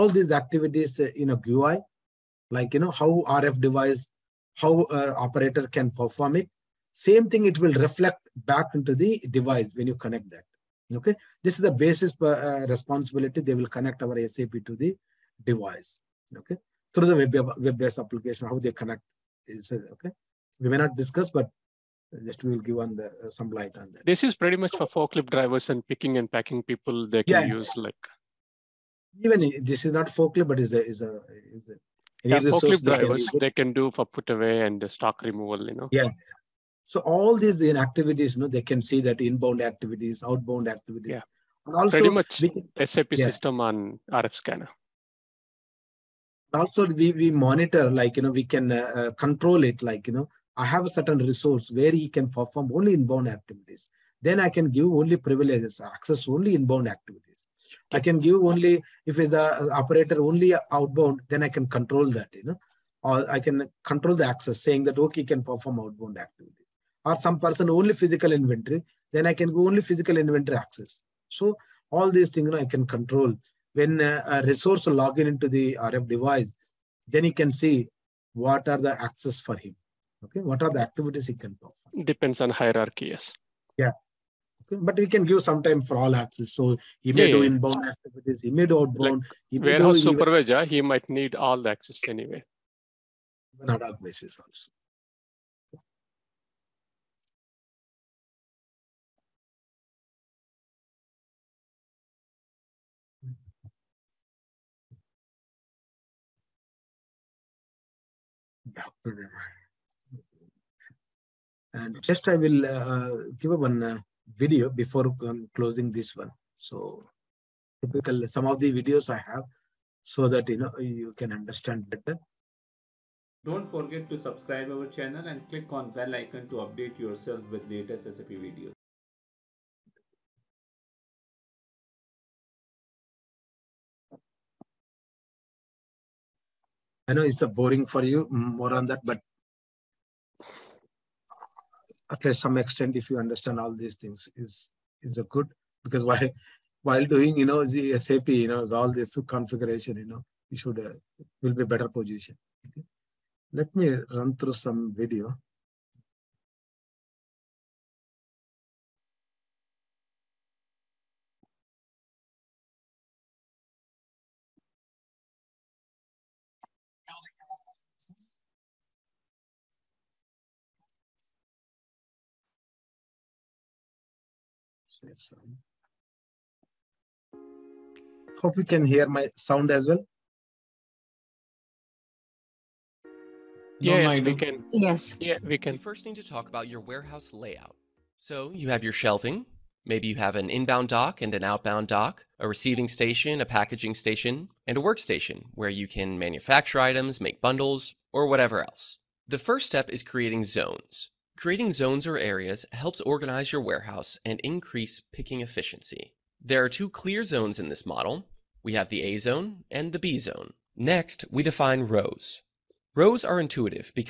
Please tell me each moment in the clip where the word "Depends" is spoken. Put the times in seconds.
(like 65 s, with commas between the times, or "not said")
82 s.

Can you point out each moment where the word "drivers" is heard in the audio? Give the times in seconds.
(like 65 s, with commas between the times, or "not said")
25 s, 32 s.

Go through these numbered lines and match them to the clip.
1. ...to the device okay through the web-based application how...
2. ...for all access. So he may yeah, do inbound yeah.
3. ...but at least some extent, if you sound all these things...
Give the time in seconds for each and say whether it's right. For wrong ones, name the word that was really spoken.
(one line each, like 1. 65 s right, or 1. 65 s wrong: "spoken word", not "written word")
1. 14 s right
2. 85 s right
3. 139 s wrong: "understand", not "sound".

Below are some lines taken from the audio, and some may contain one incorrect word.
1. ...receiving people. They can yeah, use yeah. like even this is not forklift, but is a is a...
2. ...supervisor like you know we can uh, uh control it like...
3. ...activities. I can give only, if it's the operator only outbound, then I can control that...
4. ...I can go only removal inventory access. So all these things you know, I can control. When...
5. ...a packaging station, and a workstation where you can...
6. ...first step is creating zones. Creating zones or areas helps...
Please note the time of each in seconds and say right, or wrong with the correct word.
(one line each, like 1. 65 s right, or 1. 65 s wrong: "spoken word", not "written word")
1. 26 s wrong: "packing", not "receiving"
2. 47 s wrong: "monitor", not "supervisor"
3. 56 s right
4. 69 s wrong: "physical", not "removal"
5. 193 s right
6. 199 s right.